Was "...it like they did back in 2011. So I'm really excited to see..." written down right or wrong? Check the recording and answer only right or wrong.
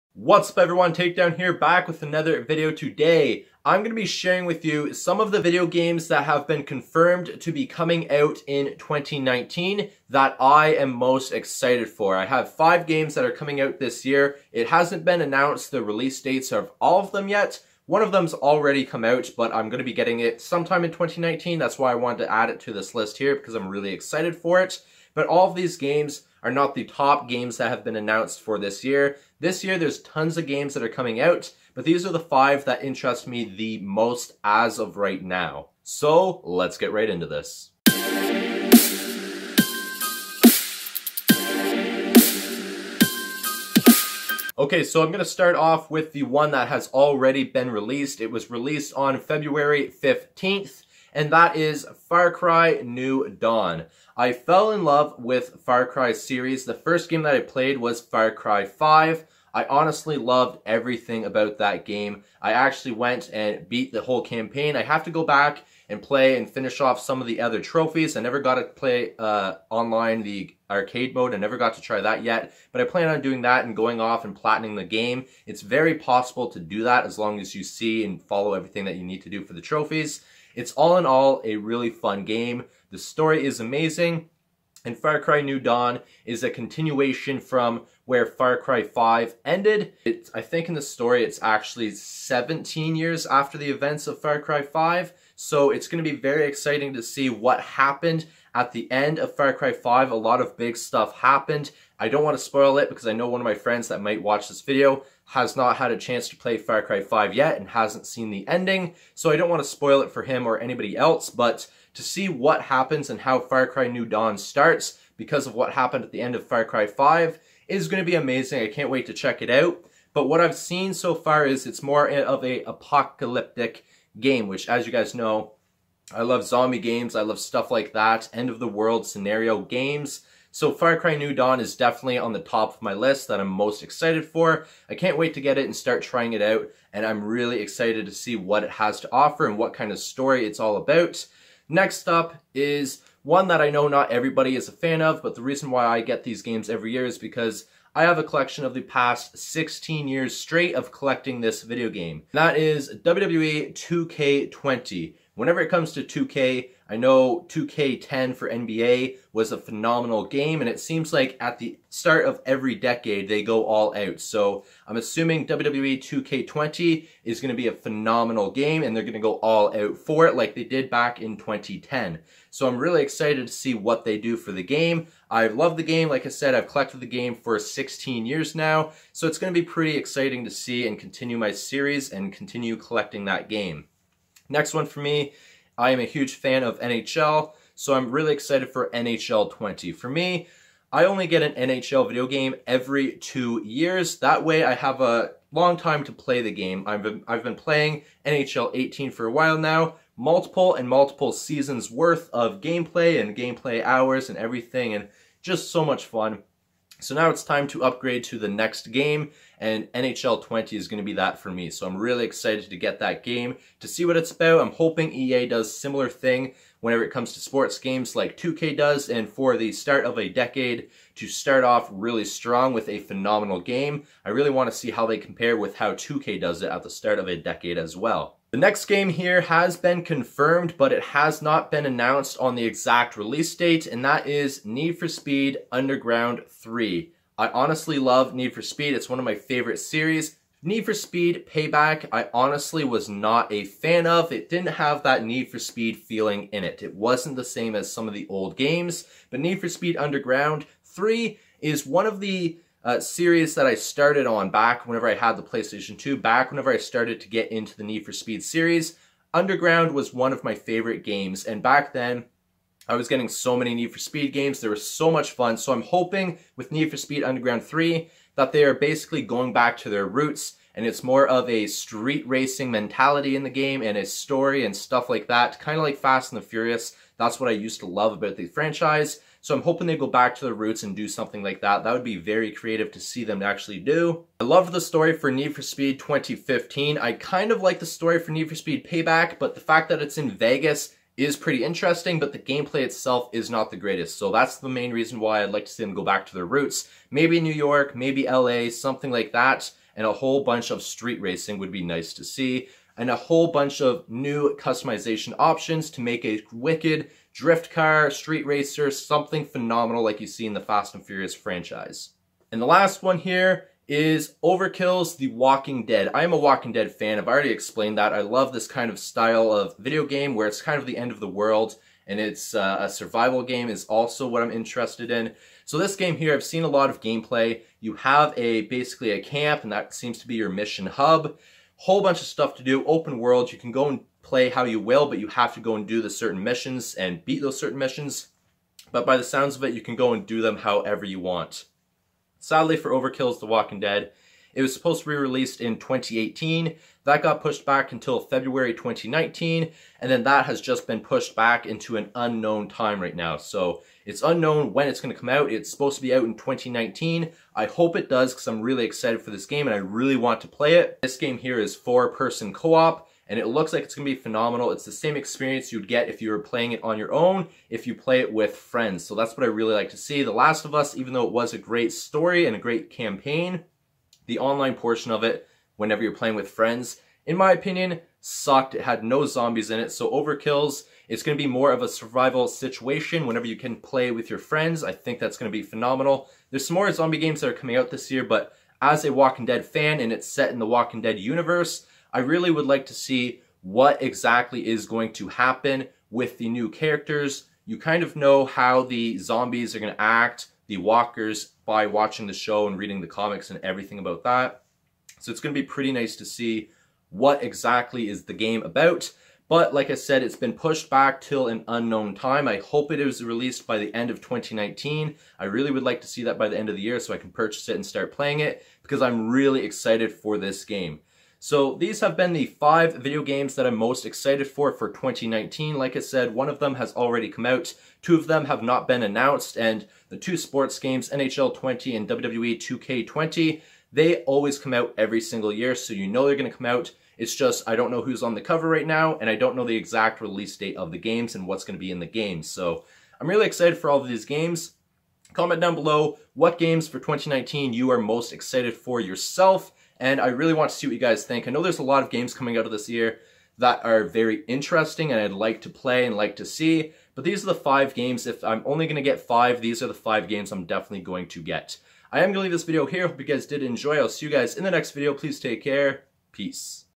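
wrong.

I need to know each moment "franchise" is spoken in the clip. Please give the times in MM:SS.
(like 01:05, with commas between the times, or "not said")
04:38, 05:11.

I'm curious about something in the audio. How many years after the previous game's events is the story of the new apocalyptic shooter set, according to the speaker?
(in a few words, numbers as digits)
17.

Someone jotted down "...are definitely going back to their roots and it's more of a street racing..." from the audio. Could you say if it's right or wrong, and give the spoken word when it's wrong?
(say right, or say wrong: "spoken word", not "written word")
wrong: "basically", not "definitely".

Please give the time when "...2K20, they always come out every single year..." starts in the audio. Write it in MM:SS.
07:12.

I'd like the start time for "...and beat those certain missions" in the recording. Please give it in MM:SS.
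05:36.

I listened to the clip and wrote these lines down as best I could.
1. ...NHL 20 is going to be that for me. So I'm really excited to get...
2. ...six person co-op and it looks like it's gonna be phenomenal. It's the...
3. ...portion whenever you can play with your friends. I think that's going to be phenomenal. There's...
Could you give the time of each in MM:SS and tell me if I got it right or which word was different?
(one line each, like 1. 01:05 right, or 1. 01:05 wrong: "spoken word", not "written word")
1. 03:29 right
2. 06:01 wrong: "four", not "six"
3. 06:22 wrong: "situation", not "portion".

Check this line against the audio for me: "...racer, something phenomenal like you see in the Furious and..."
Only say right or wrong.
wrong.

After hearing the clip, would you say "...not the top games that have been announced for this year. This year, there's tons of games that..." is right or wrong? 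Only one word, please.
right.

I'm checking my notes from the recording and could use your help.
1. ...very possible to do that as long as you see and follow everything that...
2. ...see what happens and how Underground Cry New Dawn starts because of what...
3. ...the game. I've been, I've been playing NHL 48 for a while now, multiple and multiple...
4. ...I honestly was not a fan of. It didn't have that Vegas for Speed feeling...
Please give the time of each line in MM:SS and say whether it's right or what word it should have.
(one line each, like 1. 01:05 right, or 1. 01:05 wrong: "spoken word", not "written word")
1. 01:15 right
2. 01:52 wrong: "Far", not "Underground"
3. 03:16 wrong: "18", not "48"
4. 04:02 wrong: "Need", not "Vegas".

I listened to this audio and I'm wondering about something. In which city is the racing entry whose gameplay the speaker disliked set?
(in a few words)
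Vegas.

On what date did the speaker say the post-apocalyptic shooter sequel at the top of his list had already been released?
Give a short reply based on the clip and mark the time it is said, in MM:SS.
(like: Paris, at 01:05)
February 15th, at 00:49.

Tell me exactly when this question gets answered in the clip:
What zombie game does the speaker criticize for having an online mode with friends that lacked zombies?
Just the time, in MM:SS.
06:10.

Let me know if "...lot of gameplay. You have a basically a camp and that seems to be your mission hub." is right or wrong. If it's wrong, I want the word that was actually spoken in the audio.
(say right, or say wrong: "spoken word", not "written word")
right.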